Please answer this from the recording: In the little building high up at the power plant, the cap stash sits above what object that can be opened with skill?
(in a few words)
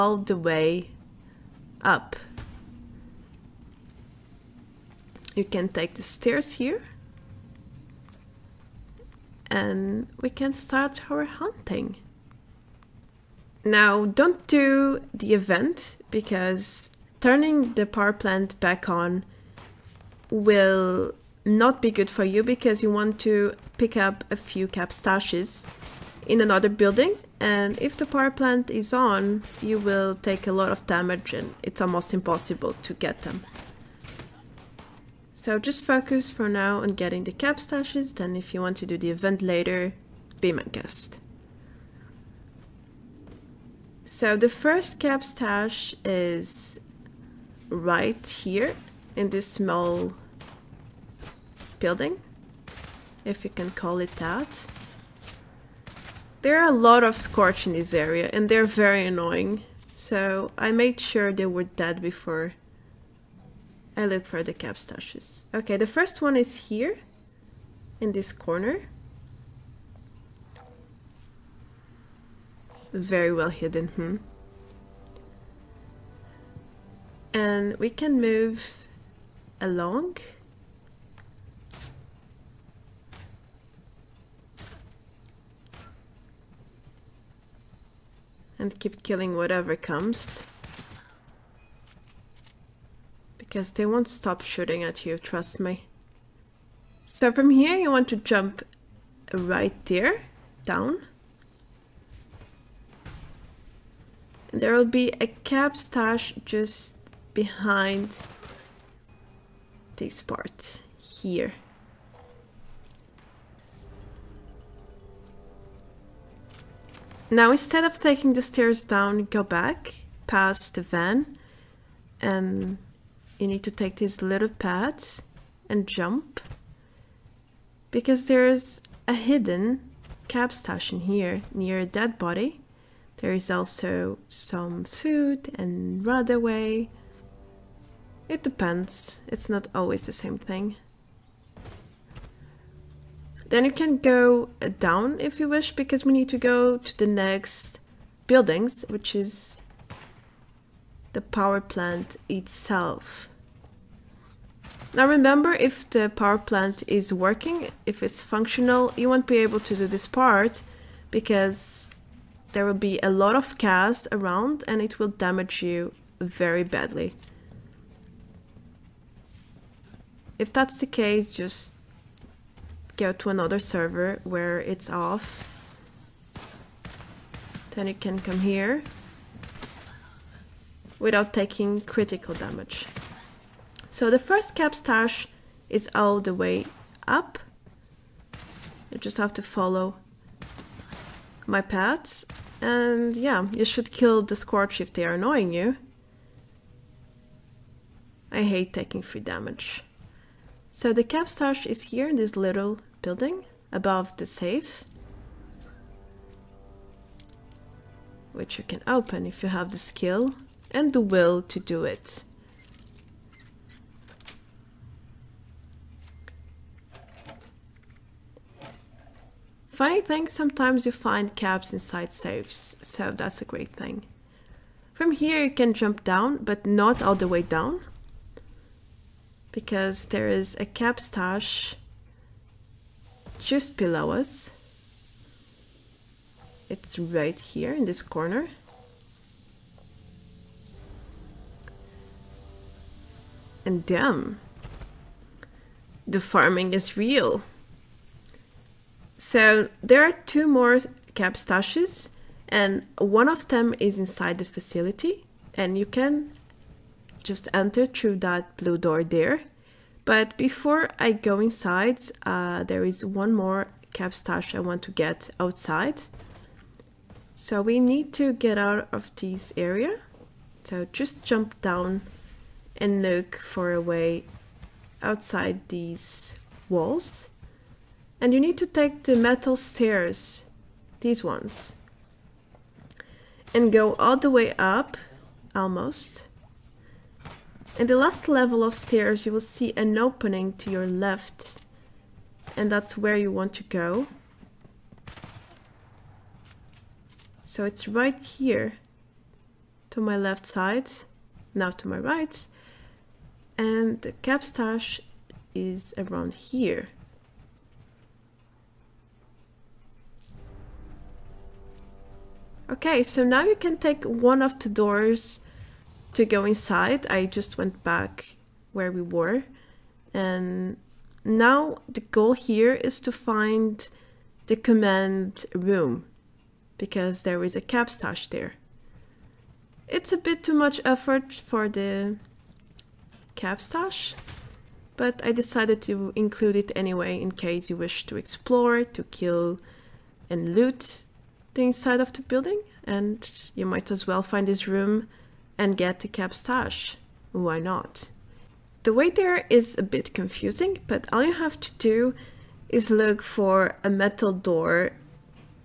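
the safe.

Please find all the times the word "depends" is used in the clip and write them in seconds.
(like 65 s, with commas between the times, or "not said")
138 s.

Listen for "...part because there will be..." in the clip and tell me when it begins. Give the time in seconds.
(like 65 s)
160 s.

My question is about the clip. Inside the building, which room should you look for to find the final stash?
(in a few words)
command room.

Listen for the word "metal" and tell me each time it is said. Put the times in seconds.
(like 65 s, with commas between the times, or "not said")
279 s, 353 s.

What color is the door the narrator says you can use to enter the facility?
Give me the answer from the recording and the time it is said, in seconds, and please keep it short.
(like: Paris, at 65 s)
blue, at 258 s.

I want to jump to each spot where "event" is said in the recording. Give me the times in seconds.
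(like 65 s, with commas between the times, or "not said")
15 s, 39 s.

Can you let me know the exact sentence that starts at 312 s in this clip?
Okay, so now you can take one of the doors to go inside, I just went back where we were.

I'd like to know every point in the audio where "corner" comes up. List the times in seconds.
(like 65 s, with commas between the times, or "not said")
68 s, 238 s.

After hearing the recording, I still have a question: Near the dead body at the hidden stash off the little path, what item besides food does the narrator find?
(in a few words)
runaway.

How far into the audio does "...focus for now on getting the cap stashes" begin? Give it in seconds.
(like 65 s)
35 s.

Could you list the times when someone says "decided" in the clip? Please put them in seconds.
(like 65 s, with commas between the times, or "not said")
335 s.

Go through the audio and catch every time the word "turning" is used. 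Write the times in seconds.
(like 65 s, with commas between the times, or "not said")
17 s.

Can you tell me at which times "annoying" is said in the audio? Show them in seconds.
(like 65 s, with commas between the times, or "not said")
59 s, 195 s.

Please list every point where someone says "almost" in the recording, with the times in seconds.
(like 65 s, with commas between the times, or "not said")
31 s, 285 s.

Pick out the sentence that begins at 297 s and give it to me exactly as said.
So it's right here to my left side, now to my right, and the capstash is around here.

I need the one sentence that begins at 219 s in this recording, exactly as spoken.
Funny thing, sometimes you find caps inside safes, so that's a great thing.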